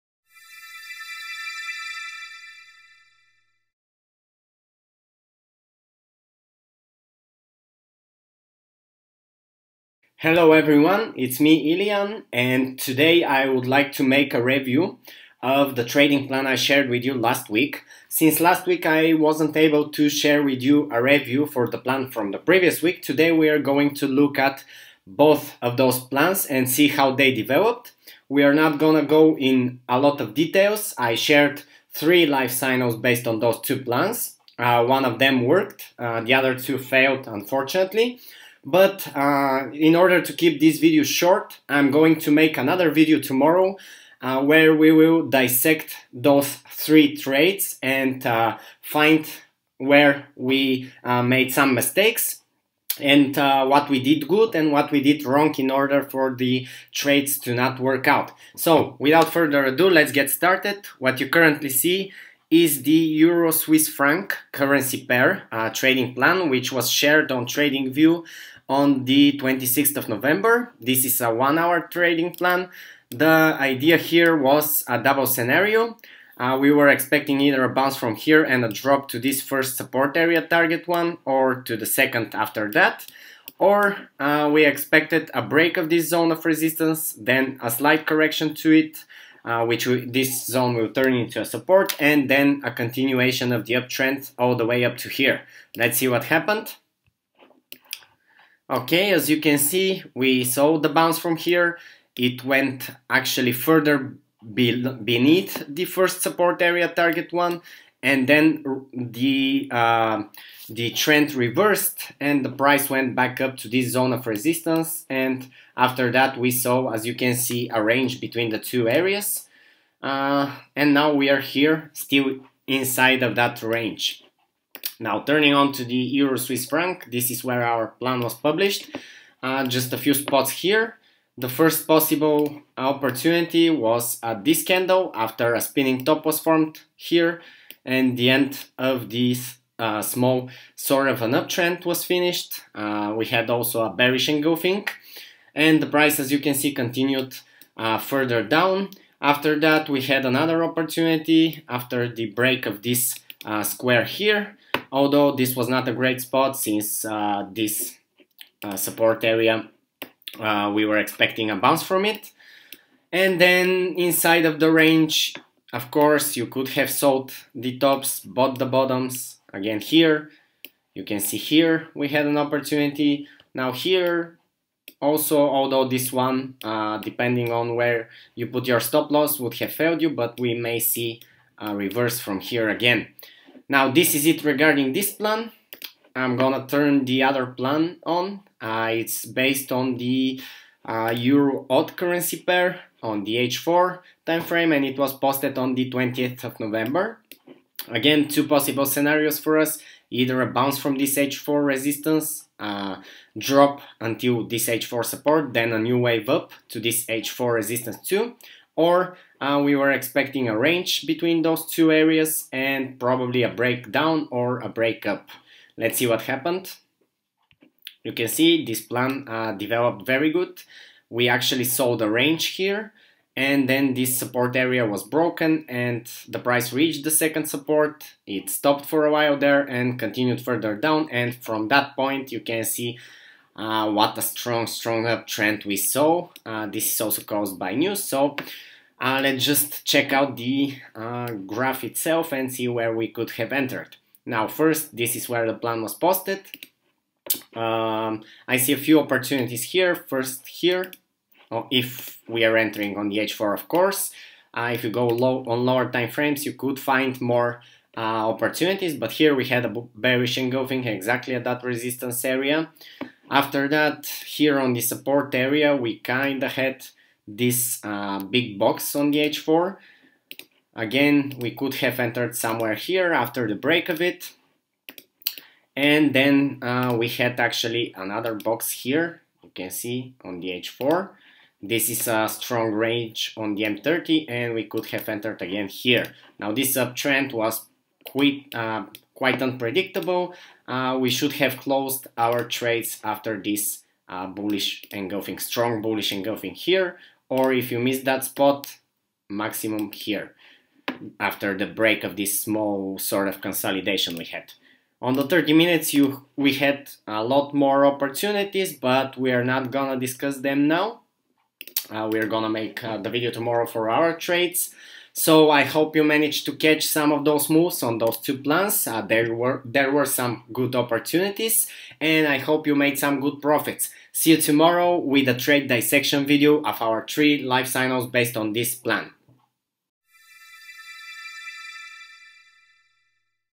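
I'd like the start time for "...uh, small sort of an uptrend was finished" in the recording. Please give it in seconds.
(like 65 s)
139 s.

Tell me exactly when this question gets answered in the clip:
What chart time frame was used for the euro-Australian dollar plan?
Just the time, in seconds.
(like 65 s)
193 s.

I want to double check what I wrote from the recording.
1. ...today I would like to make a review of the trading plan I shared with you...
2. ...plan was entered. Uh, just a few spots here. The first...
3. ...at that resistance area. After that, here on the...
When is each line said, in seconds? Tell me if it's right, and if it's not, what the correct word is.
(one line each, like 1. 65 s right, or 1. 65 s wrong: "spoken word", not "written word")
1. 12 s right
2. 127 s wrong: "published", not "entered"
3. 261 s right.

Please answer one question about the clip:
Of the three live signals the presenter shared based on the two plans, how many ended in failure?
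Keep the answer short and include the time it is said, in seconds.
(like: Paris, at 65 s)
2, at 36 s.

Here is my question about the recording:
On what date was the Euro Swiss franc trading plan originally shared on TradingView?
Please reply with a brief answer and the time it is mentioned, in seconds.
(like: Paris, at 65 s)
26th of November, at 69 s.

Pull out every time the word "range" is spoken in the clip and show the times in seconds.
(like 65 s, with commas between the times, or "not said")
117 s, 123 s, 164 s, 210 s, 222 s, 282 s.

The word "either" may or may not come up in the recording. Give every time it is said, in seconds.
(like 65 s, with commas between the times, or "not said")
77 s, 200 s.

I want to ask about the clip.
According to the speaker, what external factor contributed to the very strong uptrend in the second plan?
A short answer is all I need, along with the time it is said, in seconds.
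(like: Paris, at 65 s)
News, at 237 s.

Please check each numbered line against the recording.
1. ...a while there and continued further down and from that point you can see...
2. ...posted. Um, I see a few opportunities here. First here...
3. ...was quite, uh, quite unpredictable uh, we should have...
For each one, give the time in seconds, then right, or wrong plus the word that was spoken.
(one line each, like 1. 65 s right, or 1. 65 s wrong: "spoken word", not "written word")
1. 229 s right
2. 245 s right
3. 287 s right.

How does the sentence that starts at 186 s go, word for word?
I'm gonna turn the other plan on.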